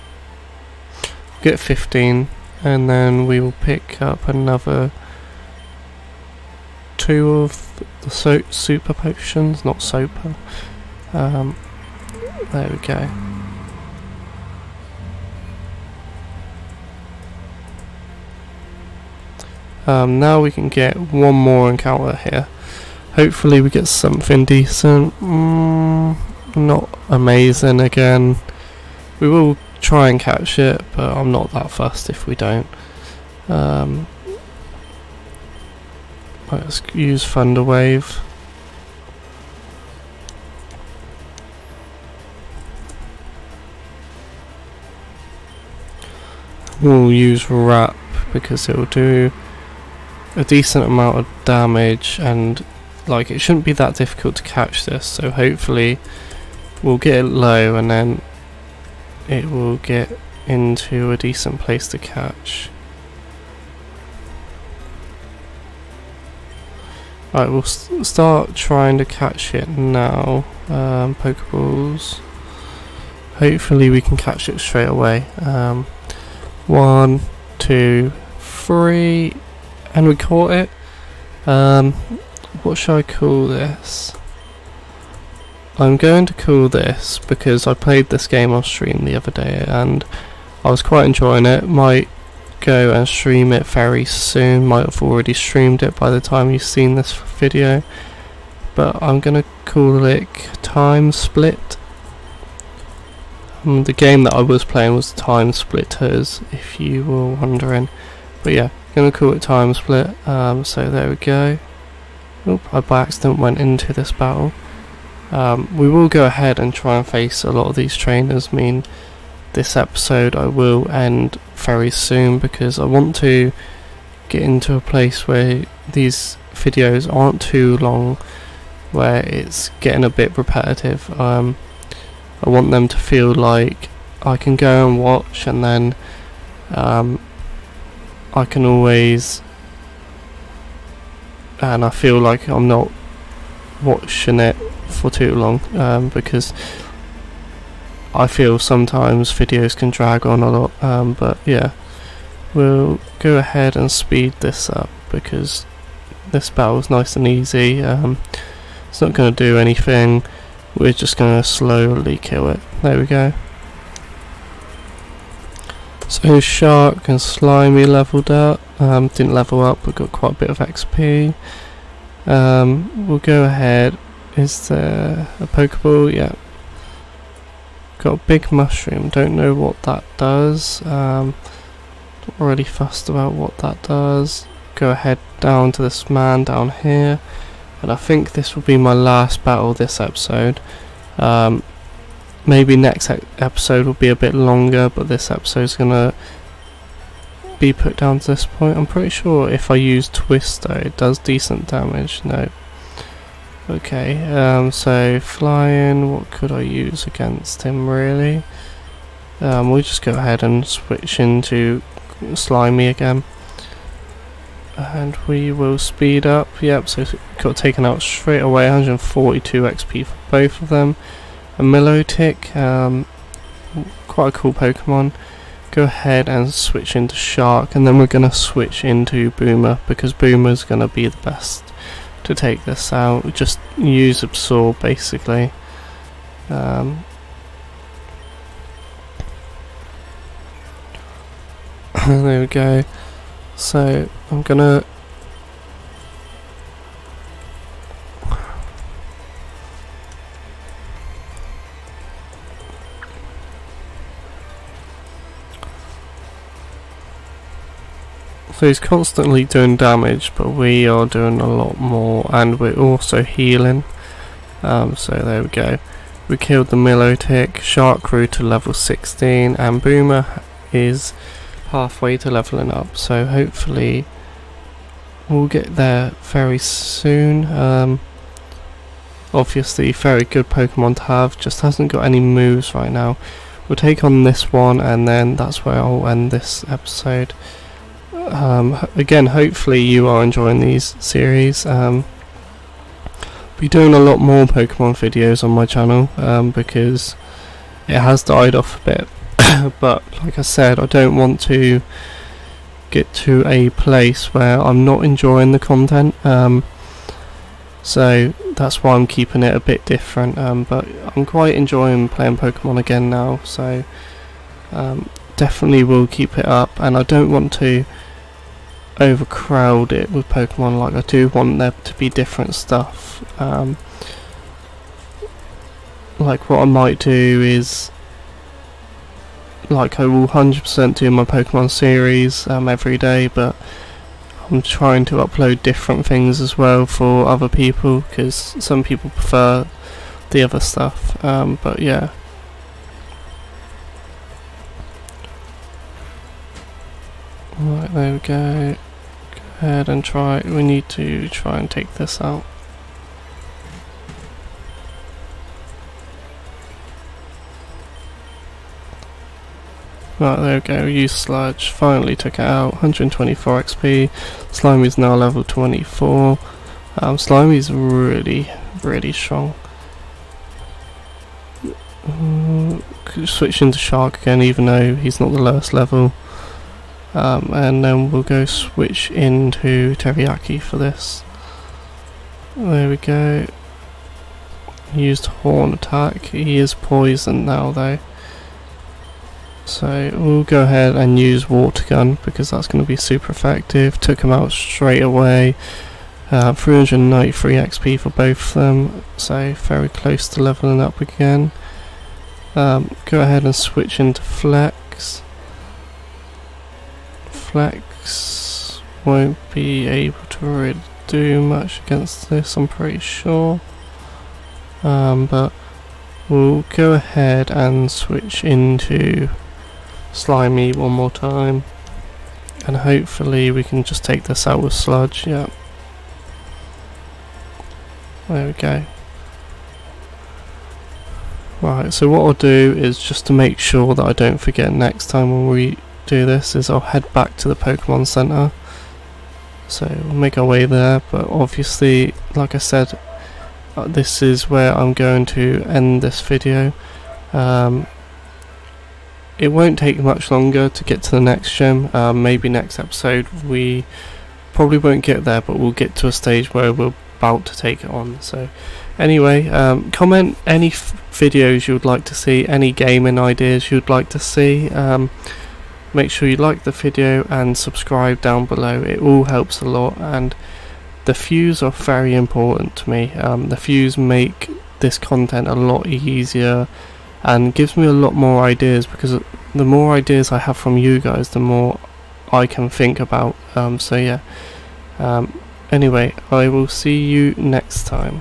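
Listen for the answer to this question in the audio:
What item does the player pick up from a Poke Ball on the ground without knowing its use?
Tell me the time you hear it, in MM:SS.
02:58.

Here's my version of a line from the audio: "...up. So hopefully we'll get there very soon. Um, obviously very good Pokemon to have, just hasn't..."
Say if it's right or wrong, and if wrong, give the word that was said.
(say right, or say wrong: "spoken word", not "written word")
right.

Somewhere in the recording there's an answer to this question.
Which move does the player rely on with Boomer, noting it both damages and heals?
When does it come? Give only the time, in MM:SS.
03:54.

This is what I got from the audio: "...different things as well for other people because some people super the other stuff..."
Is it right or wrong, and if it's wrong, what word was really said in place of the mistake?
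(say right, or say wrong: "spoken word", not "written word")
wrong: "prefer", not "super".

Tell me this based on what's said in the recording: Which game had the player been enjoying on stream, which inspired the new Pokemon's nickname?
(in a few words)
Time Splitters.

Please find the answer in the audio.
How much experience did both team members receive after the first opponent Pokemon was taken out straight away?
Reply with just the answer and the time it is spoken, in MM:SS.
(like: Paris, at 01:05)
142, at 03:38.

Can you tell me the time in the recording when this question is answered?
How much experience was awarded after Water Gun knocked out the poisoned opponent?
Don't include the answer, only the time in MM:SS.
06:36.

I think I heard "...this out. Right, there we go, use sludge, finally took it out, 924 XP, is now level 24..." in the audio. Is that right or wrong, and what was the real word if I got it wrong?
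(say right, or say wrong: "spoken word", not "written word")
wrong: "124", not "924".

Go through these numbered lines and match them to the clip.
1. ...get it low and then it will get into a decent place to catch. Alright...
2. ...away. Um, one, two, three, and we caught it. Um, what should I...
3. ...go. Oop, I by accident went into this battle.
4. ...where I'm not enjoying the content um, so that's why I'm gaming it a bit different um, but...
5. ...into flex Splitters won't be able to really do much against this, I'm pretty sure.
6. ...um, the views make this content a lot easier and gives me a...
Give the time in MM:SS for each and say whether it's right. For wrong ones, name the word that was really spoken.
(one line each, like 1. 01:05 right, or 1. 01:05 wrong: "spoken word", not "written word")
1. 00:56 right
2. 01:14 right
3. 01:51 right
4. 05:04 wrong: "keeping", not "gaming"
5. 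06:43 wrong: "Flex", not "Splitters"
6. 07:53 right.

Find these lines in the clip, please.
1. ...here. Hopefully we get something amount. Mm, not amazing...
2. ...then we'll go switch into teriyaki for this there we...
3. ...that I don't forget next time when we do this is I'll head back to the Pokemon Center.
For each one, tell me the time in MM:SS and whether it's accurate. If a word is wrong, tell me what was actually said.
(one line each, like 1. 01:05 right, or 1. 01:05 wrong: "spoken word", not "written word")
1. 00:22 wrong: "decent", not "amount"
2. 06:17 right
3. 07:13 right.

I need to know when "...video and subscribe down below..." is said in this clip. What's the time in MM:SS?
07:46.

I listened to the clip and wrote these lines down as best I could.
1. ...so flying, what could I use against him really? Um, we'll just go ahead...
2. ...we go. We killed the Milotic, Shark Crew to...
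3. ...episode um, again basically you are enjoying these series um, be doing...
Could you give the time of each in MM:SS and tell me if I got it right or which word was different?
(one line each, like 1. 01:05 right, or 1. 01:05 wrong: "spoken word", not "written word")
1. 03:24 right
2. 04:25 right
3. 04:46 wrong: "hopefully", not "basically".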